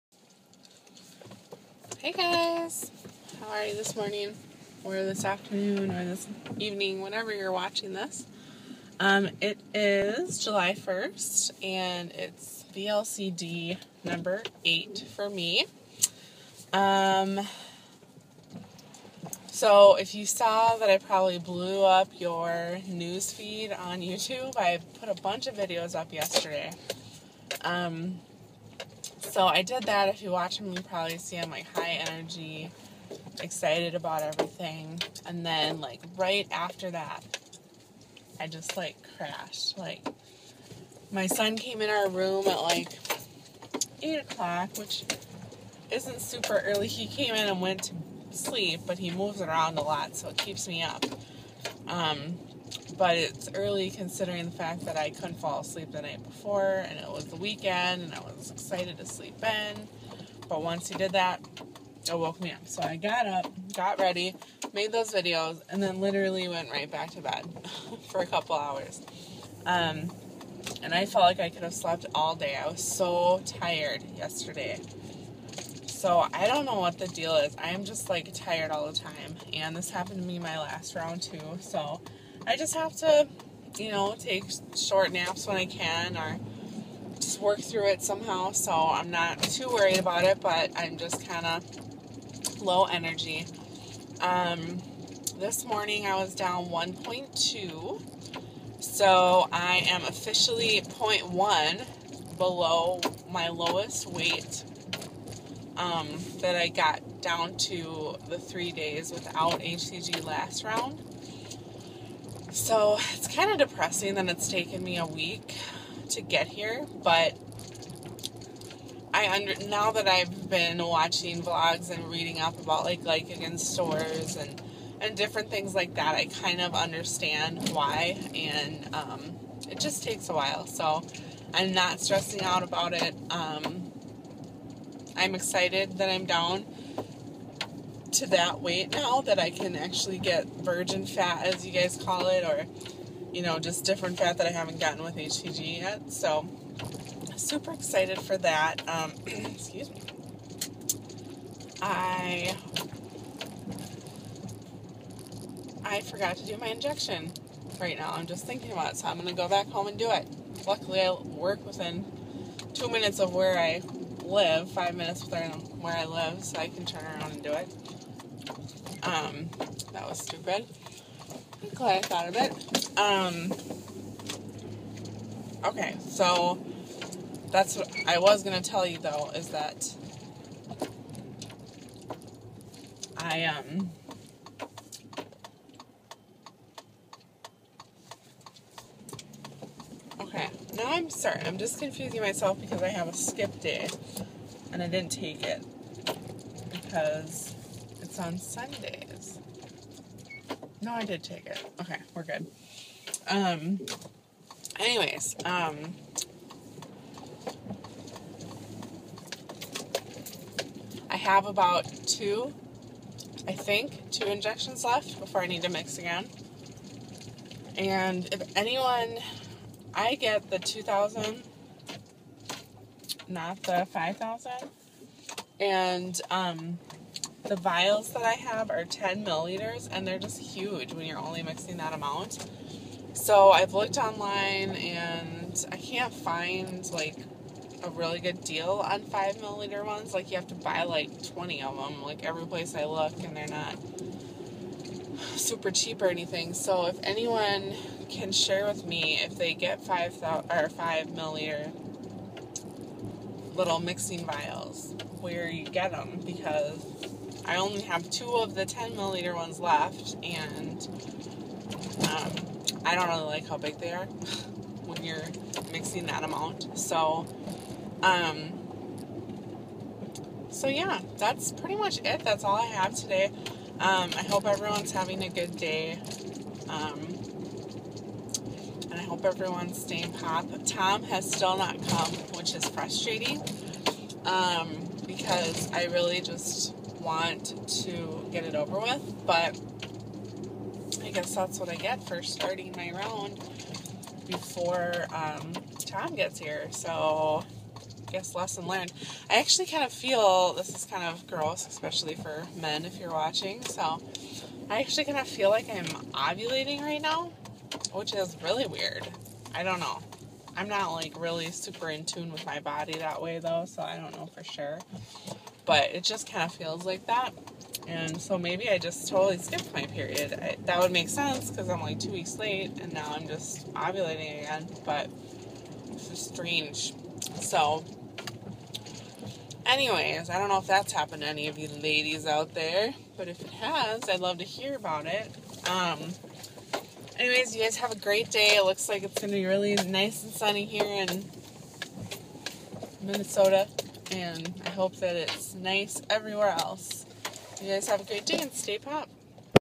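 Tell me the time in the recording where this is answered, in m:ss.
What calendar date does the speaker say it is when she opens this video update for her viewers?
0:10.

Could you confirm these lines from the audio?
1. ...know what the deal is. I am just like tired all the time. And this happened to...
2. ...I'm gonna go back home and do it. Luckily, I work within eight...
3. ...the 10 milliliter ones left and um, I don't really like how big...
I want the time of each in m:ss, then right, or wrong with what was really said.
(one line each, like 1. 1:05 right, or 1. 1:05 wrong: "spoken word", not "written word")
1. 1:16 right
2. 2:39 wrong: "two", not "eight"
3. 4:18 right.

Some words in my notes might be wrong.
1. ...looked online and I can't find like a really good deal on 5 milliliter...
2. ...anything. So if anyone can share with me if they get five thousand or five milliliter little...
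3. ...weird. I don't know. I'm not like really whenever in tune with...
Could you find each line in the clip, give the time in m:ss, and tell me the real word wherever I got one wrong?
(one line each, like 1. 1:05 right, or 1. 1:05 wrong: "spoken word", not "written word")
1. 3:53 right
2. 4:06 right
3. 5:08 wrong: "super", not "whenever".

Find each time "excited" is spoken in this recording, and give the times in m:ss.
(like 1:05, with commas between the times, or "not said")
0:33, 0:58, 2:15, 2:27.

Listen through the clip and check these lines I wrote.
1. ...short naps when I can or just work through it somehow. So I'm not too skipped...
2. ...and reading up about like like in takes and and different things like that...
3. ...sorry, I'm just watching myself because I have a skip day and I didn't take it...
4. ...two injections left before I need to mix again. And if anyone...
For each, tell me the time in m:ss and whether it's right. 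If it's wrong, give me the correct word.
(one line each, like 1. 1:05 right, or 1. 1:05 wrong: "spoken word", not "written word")
1. 1:24 wrong: "worried", not "skipped"
2. 2:01 wrong: "stores", not "takes"
3. 3:11 wrong: "confusing", not "watching"
4. 3:34 right.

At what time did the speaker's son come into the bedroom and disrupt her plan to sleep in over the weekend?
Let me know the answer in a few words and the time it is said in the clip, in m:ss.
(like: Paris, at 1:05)
8 o'clock, at 0:44.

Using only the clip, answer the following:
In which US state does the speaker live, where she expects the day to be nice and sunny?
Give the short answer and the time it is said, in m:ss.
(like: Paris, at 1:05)
Minnesota, at 5:43.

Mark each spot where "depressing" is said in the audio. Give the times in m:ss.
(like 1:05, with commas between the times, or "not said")
1:53.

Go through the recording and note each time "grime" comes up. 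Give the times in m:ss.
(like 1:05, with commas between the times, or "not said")
not said.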